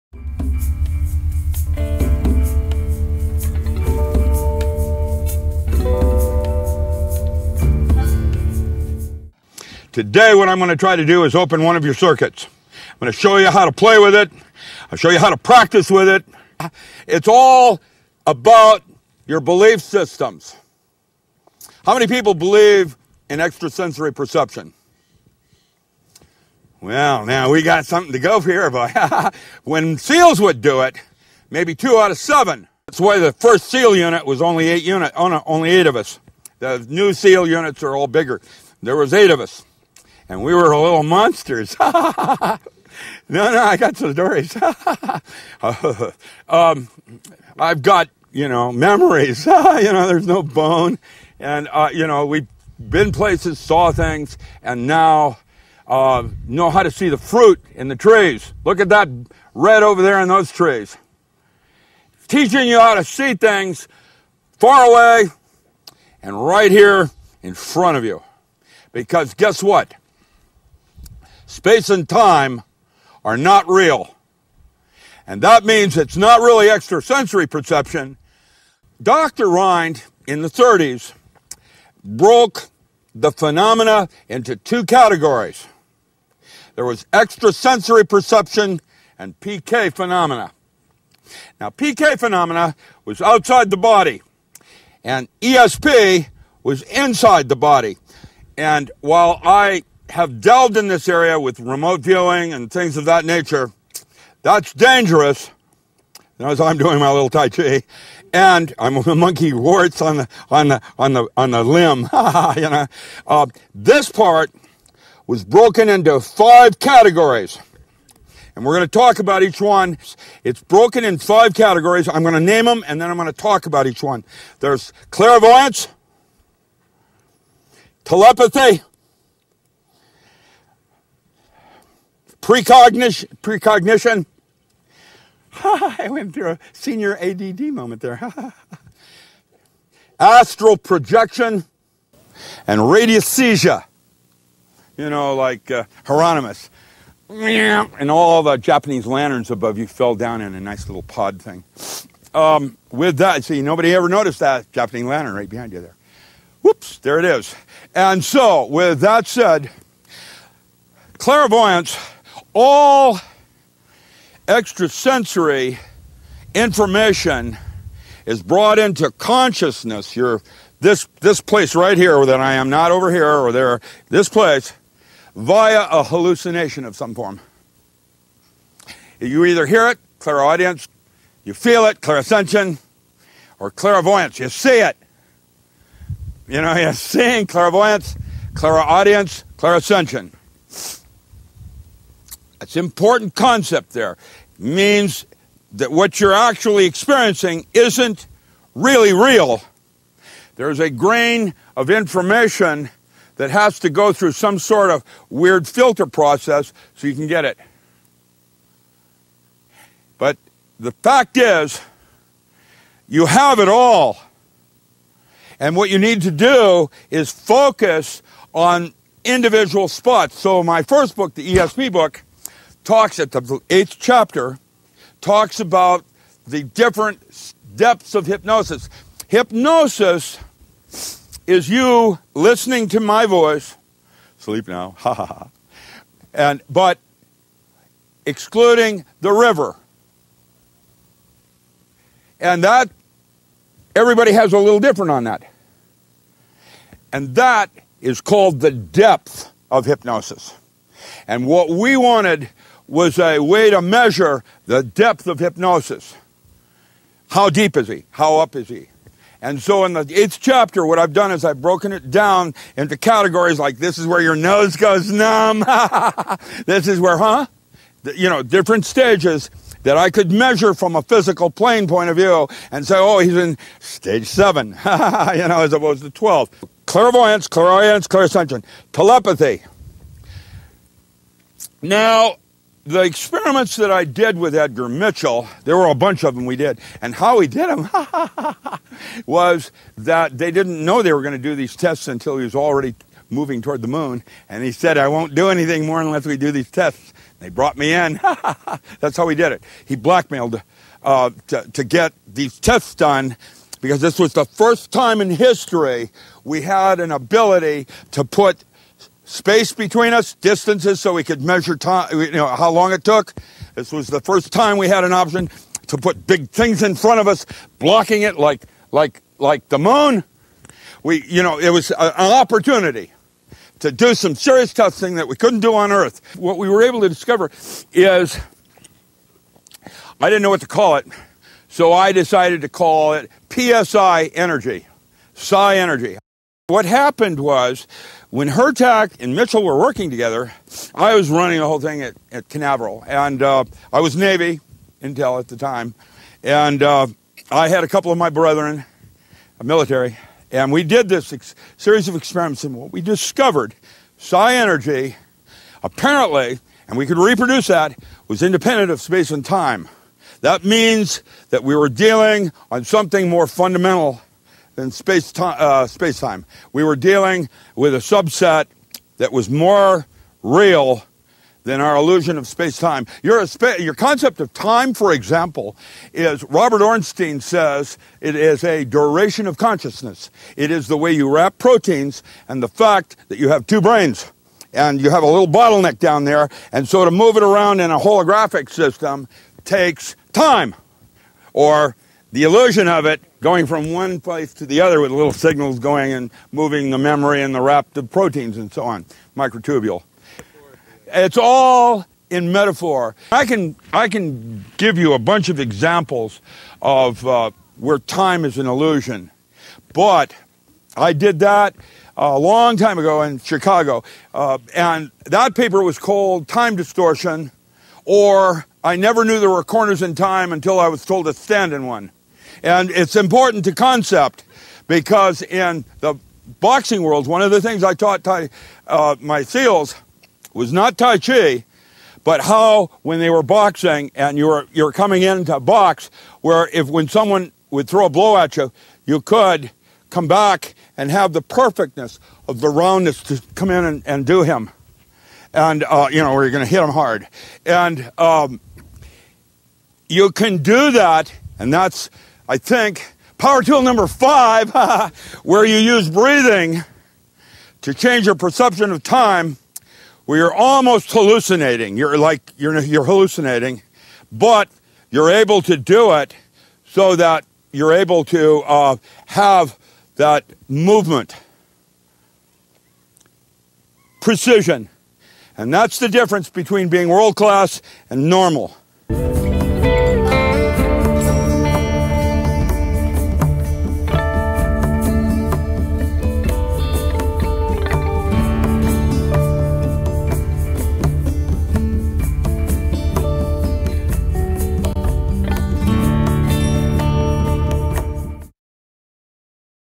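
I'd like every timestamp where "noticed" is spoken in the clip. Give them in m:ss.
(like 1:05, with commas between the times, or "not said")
2:34.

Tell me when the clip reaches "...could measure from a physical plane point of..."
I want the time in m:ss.
4:30.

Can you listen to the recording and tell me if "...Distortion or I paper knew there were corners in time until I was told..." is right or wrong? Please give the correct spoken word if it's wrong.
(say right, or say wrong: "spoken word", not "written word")
wrong: "never", not "paper".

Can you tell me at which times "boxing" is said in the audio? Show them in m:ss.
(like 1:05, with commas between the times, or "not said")
7:06, 7:13.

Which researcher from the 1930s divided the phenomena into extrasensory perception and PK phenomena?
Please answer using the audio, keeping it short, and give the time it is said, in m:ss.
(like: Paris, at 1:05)
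Dr. Rhine, at 1:19.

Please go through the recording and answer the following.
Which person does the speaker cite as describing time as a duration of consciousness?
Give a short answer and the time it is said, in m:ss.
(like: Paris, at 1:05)
Robert Ornstein, at 6:16.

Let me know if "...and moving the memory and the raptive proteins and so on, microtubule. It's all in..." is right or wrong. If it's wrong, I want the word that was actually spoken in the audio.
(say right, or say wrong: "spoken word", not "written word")
right.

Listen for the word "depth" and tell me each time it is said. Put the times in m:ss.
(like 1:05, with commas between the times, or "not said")
3:47, 4:08, 4:14.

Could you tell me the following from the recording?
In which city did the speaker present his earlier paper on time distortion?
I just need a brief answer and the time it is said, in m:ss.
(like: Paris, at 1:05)
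Chicago, at 6:53.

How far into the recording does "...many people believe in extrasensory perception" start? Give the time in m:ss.
0:21.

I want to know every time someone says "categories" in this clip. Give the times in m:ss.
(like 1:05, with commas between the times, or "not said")
1:24, 1:56, 2:01, 4:22.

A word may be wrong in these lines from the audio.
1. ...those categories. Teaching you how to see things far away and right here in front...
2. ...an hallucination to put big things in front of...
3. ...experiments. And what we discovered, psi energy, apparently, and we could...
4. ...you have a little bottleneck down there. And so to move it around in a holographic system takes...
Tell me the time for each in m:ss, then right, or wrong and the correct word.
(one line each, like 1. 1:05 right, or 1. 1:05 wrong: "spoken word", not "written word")
1. 1:00 wrong: "trees", not "categories"
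2. 5:15 wrong: "option", not "hallucination"
3. 5:52 right
4. 6:24 right.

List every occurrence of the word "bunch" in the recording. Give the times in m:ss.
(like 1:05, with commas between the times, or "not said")
4:45, 6:45.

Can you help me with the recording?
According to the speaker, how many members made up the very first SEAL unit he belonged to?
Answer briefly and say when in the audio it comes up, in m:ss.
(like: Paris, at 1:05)
8, at 0:35.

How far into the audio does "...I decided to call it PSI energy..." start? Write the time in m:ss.
5:31.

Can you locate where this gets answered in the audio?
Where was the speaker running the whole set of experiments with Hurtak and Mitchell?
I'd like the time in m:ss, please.
5:42.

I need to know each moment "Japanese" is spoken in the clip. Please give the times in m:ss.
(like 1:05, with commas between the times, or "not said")
2:28, 2:34.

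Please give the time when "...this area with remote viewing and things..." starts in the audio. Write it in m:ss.
1:40.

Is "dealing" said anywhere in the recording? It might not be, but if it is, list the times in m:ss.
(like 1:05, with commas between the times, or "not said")
6:01, 6:06.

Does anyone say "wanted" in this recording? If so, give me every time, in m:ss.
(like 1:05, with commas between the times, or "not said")
4:11.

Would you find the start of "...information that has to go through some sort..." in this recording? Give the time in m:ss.
3:21.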